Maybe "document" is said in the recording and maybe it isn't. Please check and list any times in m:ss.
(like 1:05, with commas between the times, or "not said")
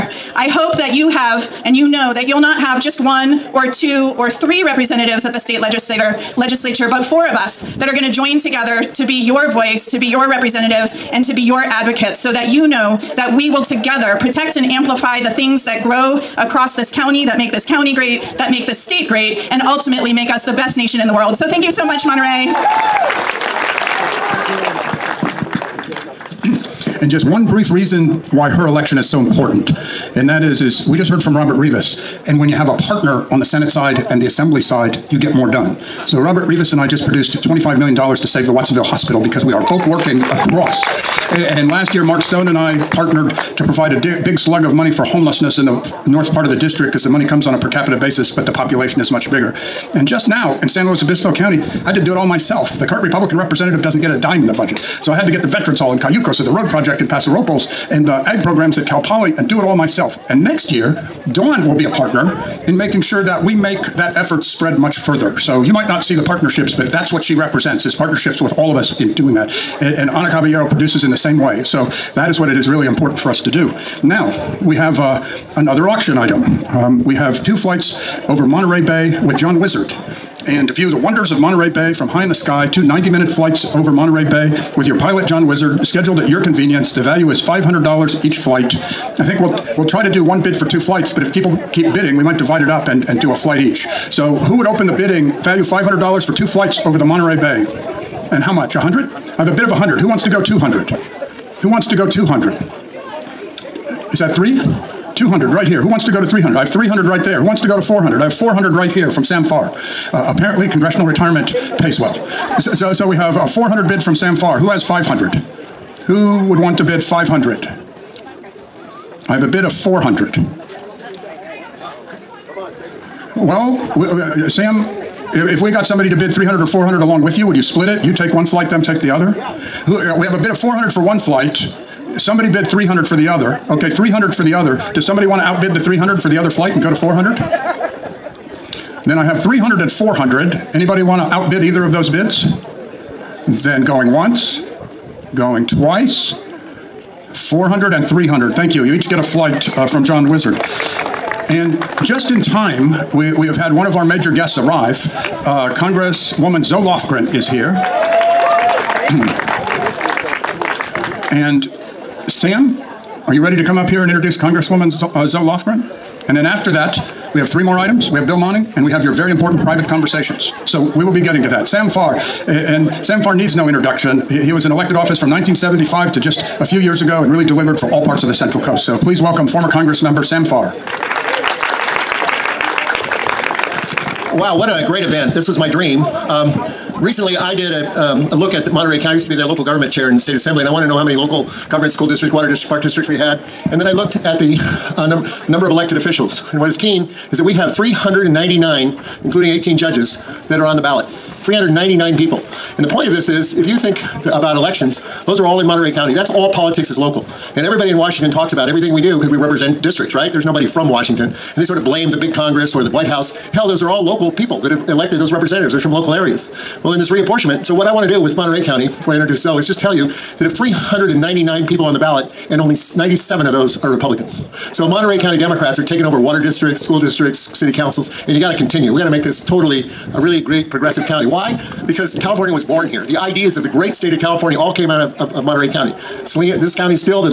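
not said.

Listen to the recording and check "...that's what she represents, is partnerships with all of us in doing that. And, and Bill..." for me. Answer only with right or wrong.
wrong.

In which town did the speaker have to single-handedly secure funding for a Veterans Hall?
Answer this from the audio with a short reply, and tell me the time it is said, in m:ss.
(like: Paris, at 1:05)
Cayucos, at 0:55.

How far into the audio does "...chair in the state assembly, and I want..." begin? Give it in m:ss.
3:09.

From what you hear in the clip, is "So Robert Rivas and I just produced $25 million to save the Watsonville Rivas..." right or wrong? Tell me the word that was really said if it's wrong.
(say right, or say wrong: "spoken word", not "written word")
wrong: "Hospital", not "Rivas".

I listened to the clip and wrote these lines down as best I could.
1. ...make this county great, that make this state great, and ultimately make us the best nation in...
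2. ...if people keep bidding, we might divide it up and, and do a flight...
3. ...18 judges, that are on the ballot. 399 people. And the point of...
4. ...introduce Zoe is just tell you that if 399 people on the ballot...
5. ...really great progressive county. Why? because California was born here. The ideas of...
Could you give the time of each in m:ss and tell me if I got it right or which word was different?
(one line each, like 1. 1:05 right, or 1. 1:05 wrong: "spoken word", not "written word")
1. 0:17 right
2. 1:31 right
3. 3:19 right
4. 3:39 right
5. 3:50 right.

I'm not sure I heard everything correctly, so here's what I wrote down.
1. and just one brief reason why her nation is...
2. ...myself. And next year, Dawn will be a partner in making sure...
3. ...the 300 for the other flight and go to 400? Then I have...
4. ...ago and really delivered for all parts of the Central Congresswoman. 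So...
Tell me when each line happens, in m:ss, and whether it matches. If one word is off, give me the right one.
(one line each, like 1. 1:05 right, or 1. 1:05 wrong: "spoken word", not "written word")
1. 0:27 wrong: "election", not "nation"
2. 0:59 right
3. 2:15 right
4. 2:56 wrong: "Coast", not "Congresswoman".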